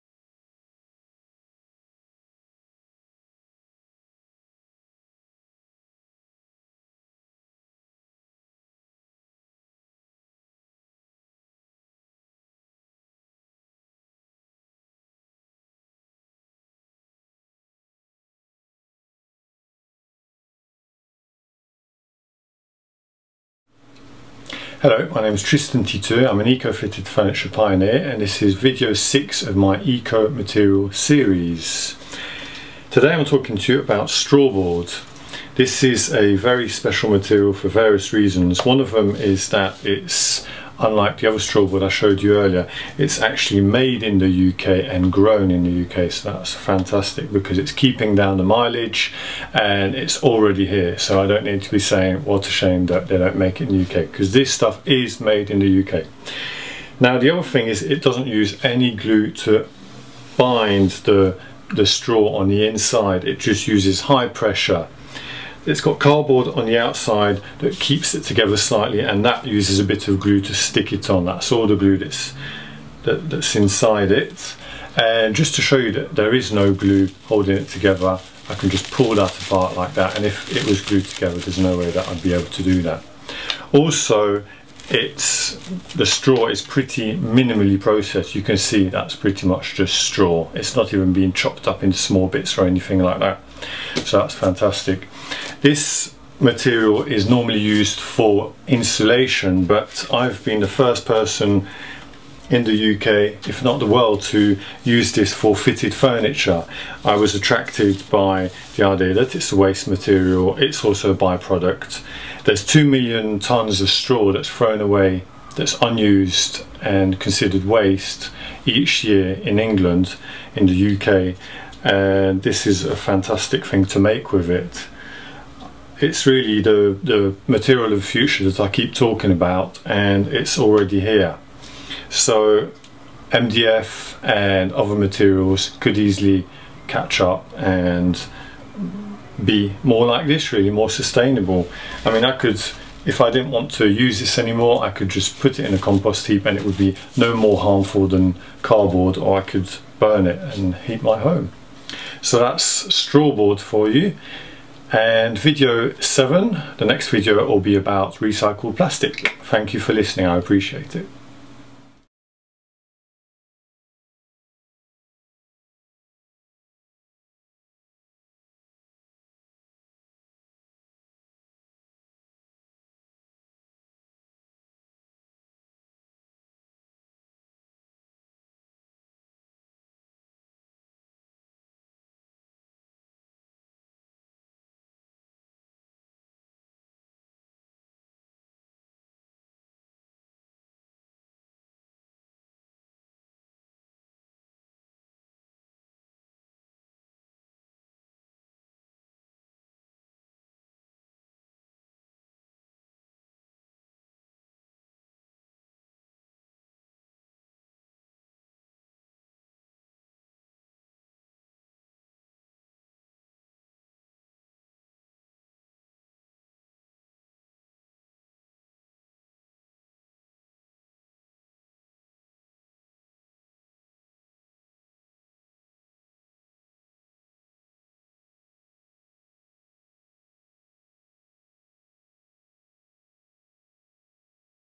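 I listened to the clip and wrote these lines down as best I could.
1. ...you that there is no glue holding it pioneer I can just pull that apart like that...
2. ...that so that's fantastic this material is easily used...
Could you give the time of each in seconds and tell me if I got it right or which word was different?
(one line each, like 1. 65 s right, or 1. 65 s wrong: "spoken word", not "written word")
1. 75 s wrong: "together", not "pioneer"
2. 93 s wrong: "normally", not "easily".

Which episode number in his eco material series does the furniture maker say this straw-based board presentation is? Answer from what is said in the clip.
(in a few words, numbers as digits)
6.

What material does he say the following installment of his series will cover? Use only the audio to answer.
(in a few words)
Recycled plastic.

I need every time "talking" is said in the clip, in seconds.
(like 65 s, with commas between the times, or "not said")
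33 s, 128 s.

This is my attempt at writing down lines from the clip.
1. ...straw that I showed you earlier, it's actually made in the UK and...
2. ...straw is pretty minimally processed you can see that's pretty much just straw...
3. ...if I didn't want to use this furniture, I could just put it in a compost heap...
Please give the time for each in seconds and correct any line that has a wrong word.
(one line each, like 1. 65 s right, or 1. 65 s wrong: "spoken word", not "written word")
1. 41 s right
2. 86 s right
3. 143 s wrong: "anymore", not "furniture".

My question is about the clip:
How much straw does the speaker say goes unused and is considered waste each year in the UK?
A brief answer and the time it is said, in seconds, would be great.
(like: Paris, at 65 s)
2 million tonnes, at 112 s.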